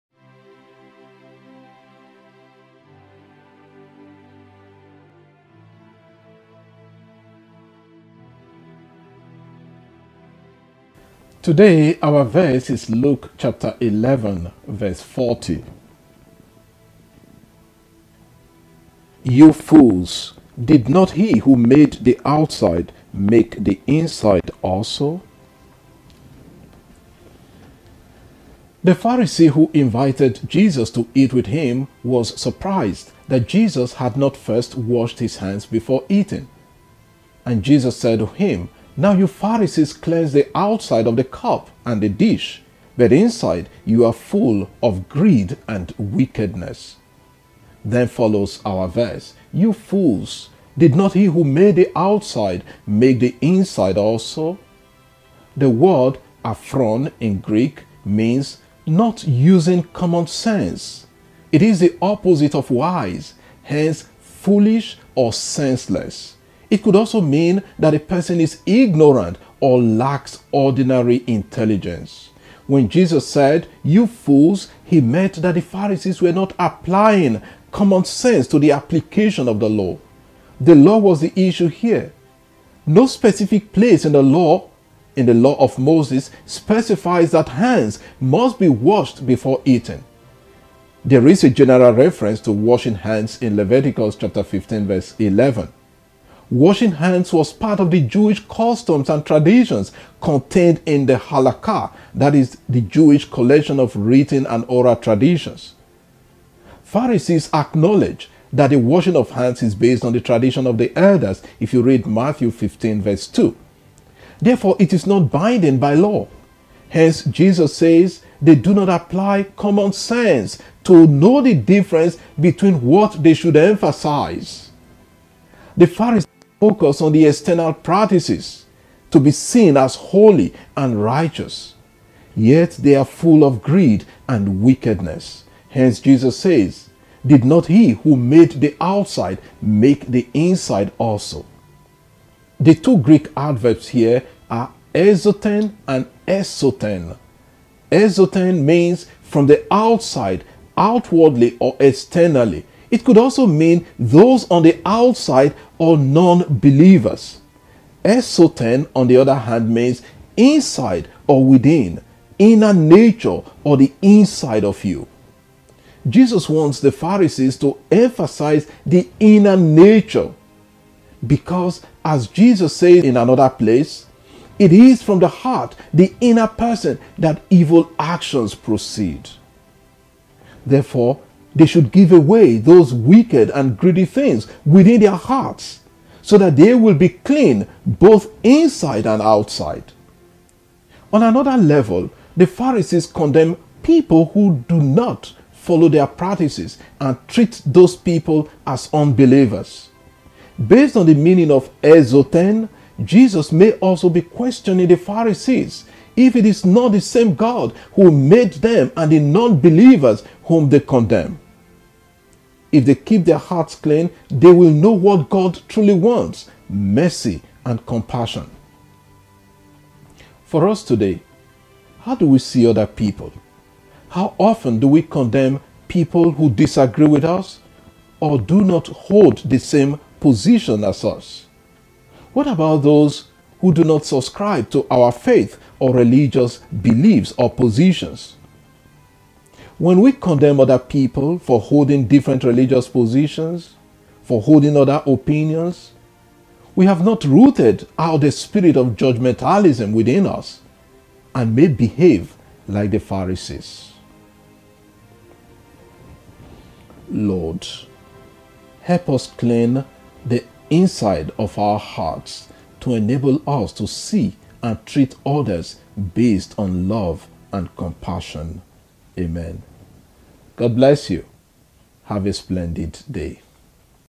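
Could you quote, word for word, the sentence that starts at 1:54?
Therefore, it is not binding by law.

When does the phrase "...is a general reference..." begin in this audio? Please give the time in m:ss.
1:31.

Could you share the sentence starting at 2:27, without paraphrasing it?
Exoten means from the outside, outwardly or externally, it could also mean those on the outside or non believers.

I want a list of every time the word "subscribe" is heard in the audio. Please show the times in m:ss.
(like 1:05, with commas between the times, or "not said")
3:54.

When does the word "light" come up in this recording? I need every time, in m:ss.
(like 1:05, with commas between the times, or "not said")
not said.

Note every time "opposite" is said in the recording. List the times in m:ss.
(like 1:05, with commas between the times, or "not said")
1:02.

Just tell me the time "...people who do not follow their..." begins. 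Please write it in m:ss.
3:13.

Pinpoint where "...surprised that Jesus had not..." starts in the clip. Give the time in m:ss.
0:32.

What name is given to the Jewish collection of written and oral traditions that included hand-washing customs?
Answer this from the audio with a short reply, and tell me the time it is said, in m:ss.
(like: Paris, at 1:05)
Halakha, at 1:41.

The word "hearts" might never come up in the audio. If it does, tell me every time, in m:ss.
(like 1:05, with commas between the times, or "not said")
2:55, 3:05, 3:33, 4:21.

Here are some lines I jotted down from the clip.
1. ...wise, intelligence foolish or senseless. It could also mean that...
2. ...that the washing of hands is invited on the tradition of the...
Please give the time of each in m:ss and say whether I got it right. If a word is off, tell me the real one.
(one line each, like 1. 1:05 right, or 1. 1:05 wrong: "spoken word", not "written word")
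1. 1:02 wrong: "hence", not "intelligence"
2. 1:48 wrong: "based", not "invited".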